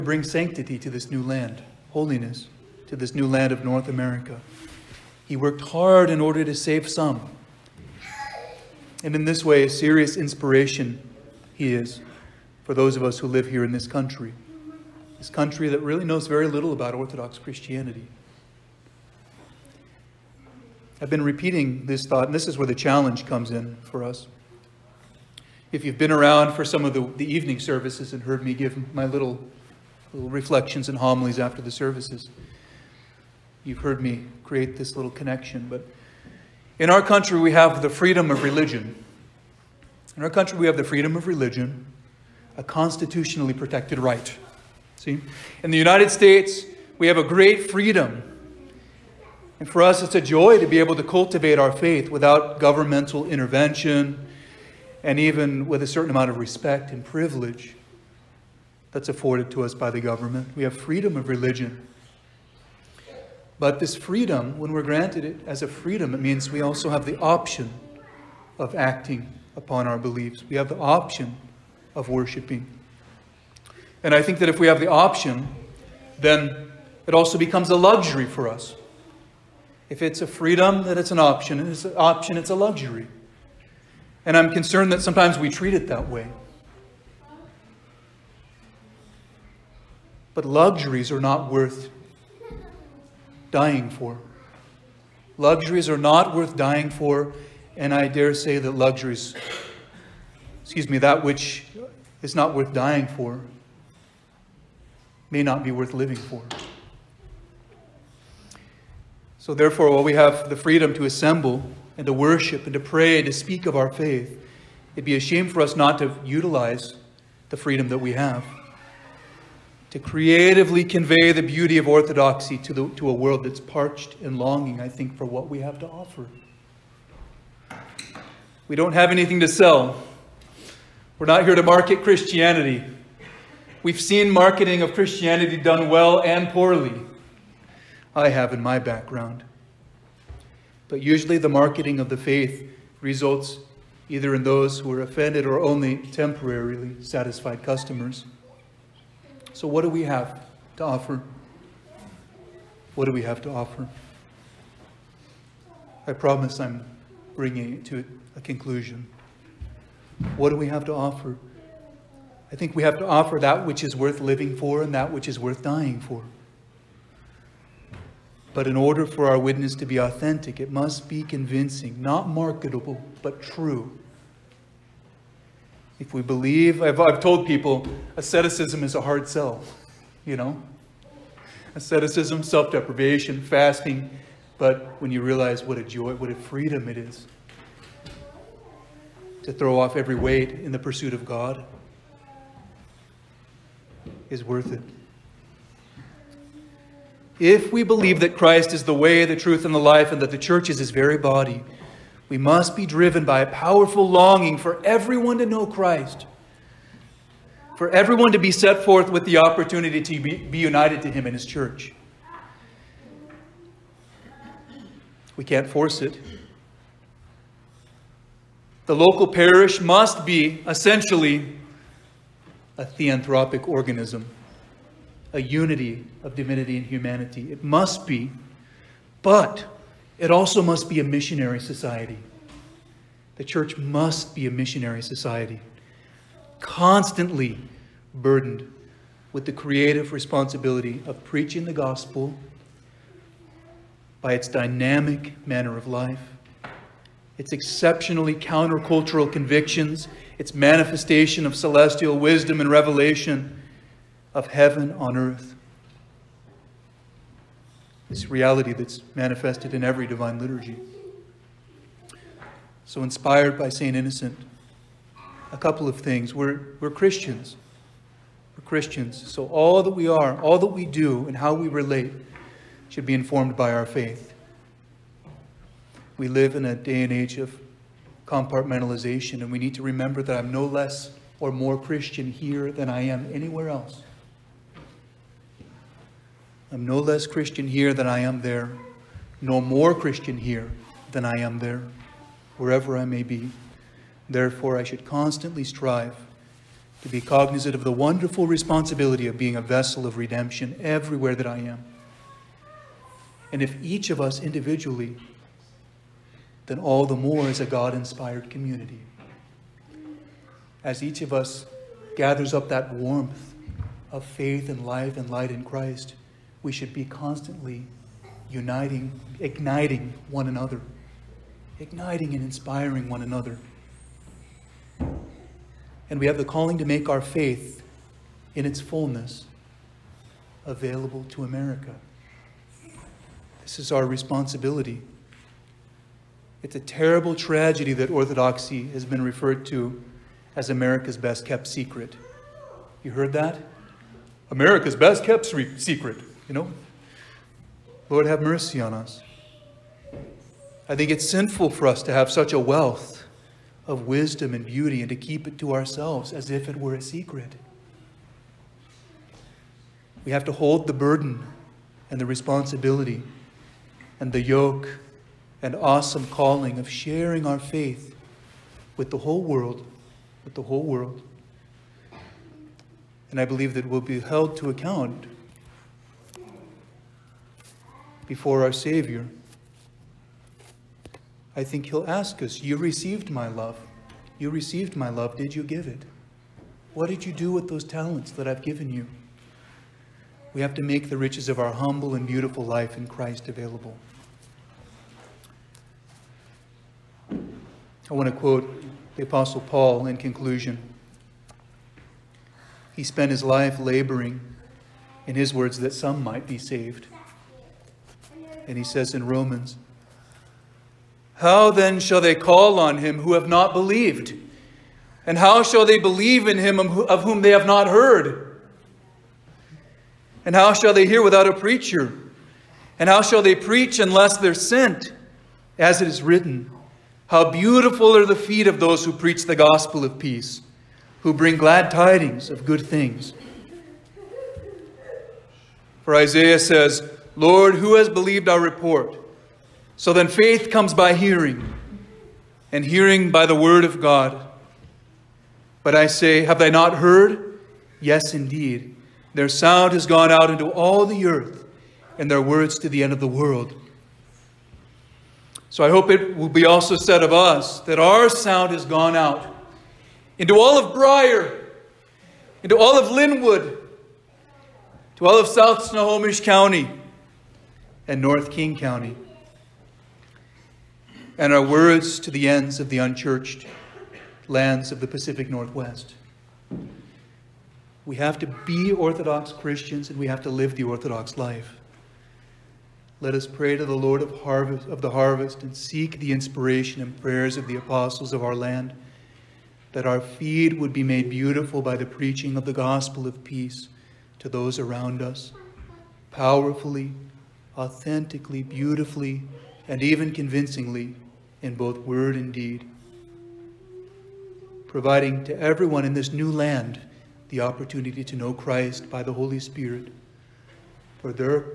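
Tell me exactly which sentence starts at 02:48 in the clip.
But in order for our witness to be authentic, it must be convincing, not marketable, but true.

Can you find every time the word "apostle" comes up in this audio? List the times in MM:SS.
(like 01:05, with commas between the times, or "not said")
06:39, 08:07.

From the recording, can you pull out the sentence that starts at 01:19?
If it's a freedom, then it's an option.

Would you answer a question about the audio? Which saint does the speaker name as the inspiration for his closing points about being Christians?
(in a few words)
St. Innocent.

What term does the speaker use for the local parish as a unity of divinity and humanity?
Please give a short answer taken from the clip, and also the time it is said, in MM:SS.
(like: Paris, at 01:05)
Theanthropic organism, at 03:42.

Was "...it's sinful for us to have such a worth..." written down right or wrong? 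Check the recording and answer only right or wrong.
wrong.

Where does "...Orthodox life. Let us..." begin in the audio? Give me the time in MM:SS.
08:00.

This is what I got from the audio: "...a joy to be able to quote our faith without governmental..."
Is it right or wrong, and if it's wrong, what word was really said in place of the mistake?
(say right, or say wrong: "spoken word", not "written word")
wrong: "cultivate", not "quote".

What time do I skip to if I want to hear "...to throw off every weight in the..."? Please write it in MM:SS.
03:09.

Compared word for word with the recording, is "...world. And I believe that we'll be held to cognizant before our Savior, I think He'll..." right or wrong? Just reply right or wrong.
wrong.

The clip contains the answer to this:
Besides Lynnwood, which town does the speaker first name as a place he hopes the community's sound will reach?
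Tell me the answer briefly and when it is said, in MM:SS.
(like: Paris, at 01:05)
Brier, at 07:40.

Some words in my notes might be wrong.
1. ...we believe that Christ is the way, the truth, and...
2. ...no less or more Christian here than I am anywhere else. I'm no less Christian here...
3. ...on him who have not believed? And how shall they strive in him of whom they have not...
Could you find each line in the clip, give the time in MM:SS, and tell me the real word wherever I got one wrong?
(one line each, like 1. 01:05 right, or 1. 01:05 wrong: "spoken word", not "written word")
1. 03:17 right
2. 04:40 right
3. 06:52 wrong: "believe", not "strive".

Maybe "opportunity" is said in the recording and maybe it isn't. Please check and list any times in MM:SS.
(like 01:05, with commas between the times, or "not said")
03:29, 08:27.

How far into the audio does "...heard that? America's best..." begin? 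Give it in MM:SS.
05:43.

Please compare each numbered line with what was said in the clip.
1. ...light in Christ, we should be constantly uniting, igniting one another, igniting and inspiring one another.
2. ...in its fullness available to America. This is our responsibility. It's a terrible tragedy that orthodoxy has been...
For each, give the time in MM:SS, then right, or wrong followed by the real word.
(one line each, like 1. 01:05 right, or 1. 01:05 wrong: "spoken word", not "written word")
1. 05:15 right
2. 05:28 right.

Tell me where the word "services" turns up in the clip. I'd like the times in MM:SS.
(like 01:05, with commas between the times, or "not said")
00:27, 00:31.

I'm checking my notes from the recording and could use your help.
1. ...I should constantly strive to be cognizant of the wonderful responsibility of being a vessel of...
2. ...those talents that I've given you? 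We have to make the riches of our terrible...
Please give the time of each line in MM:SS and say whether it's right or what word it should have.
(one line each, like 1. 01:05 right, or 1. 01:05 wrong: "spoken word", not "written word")
1. 04:54 right
2. 06:27 wrong: "humble", not "terrible".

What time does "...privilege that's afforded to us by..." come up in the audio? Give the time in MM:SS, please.
00:57.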